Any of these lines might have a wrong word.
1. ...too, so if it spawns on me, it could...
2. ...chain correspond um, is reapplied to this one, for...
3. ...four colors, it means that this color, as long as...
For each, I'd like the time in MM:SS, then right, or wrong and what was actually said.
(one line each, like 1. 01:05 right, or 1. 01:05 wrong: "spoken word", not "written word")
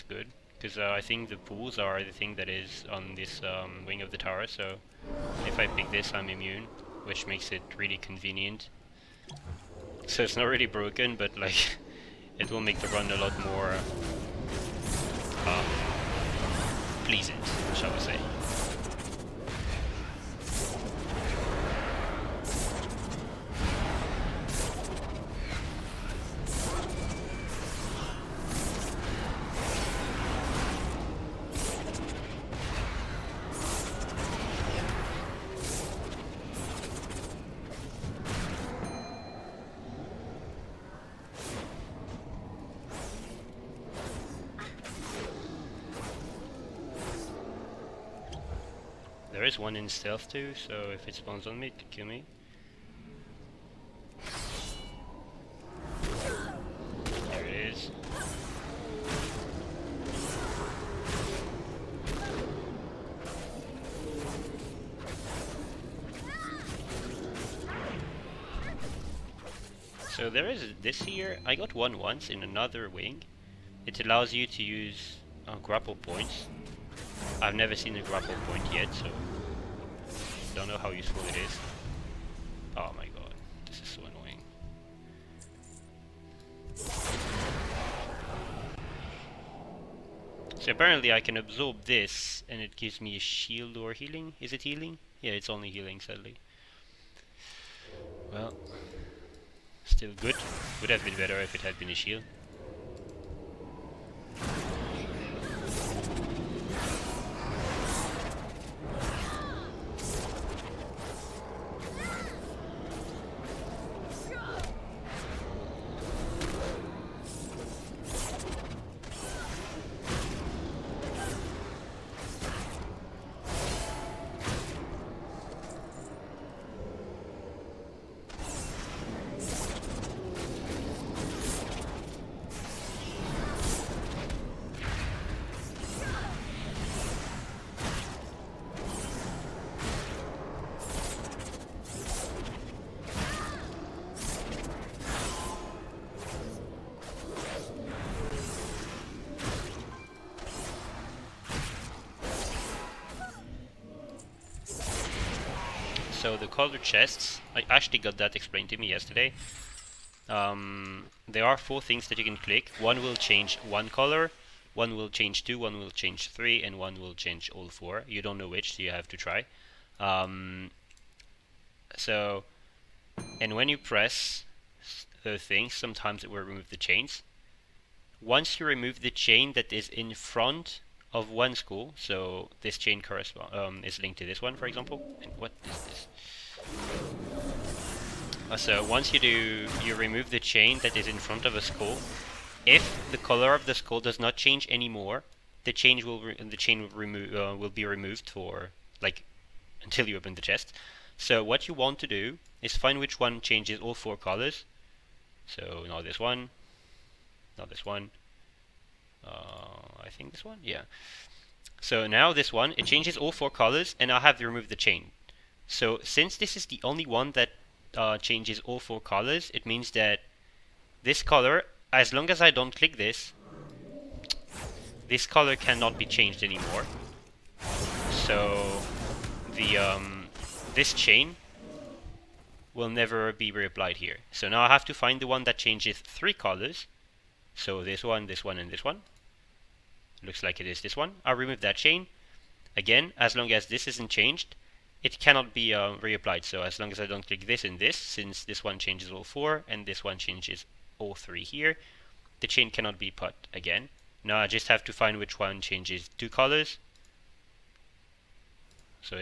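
1. 00:50 right
2. 03:02 wrong: "linked", not "reapplied"
3. 03:38 right.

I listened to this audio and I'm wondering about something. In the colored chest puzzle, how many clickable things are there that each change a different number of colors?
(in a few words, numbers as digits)
4.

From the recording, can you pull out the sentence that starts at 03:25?
So not this one, not this one, uh, I think this one, yeah.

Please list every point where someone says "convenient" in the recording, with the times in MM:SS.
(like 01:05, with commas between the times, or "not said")
00:07.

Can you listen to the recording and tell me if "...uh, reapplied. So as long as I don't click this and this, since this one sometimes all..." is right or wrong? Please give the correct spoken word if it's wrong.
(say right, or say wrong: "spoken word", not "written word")
wrong: "changes", not "sometimes".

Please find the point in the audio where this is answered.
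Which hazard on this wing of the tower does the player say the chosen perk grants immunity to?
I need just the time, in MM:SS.
00:01.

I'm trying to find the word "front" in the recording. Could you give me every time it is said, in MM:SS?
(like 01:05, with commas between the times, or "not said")
03:00, 03:11.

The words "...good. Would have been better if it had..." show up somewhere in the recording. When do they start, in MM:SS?
01:40.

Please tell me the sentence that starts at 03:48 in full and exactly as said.
So the um, this chain will never be reapplied here.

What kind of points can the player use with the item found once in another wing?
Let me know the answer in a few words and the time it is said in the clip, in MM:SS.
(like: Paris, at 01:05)
Grapple points, at 01:15.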